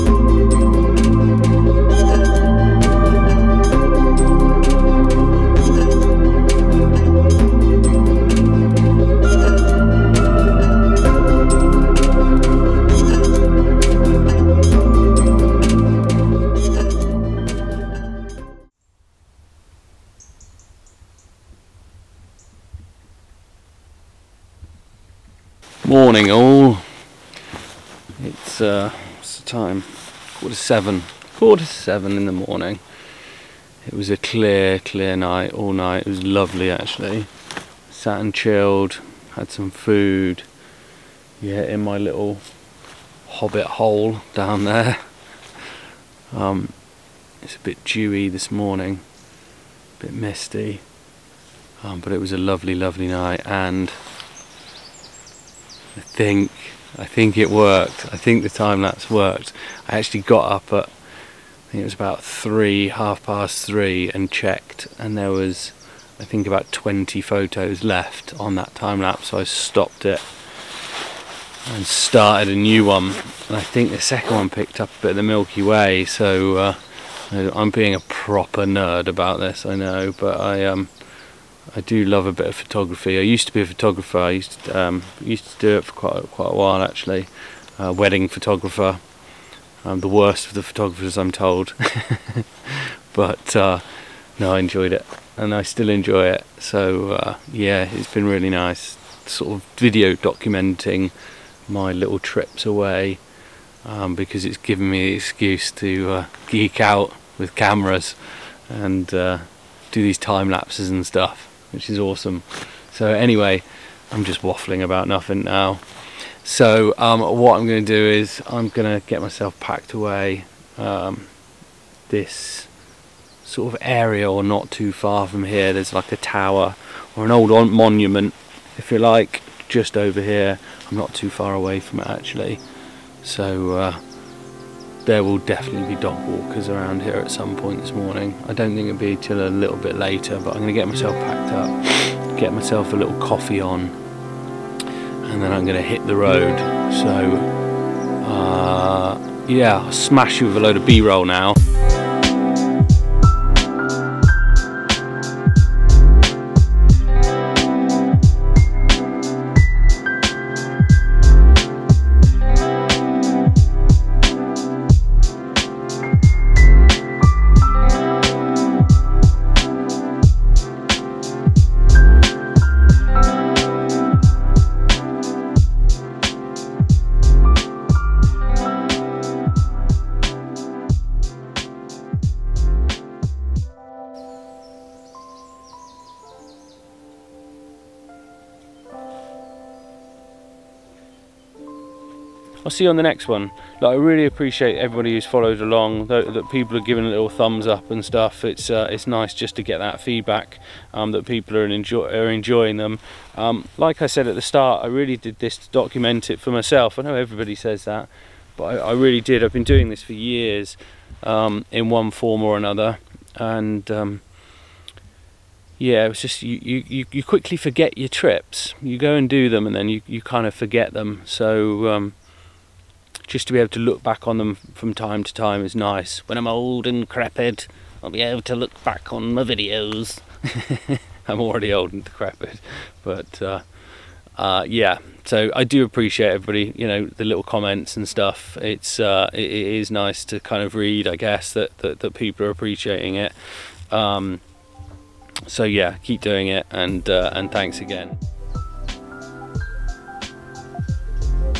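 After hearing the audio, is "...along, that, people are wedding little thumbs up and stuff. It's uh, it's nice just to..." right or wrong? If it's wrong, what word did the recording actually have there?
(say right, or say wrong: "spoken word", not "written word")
wrong: "giving", not "wedding".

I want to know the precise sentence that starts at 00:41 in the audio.
Yeah, in my little hobbit hole down there.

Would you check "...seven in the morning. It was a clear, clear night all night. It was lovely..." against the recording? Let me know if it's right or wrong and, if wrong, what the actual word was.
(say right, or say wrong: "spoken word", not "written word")
right.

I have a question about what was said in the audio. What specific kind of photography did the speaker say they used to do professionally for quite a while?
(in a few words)
Wedding photographer.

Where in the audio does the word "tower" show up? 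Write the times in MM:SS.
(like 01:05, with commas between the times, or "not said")
02:06.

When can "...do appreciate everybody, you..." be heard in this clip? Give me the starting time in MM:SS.
03:55.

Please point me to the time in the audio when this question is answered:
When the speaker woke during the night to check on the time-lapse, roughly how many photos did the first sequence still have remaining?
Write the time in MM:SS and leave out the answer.
01:06.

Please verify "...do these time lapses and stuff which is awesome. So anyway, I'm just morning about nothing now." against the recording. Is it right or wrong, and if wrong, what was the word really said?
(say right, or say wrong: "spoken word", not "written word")
wrong: "waffling", not "morning".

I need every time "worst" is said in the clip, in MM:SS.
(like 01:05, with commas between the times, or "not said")
01:30.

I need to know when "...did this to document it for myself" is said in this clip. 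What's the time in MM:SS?
03:25.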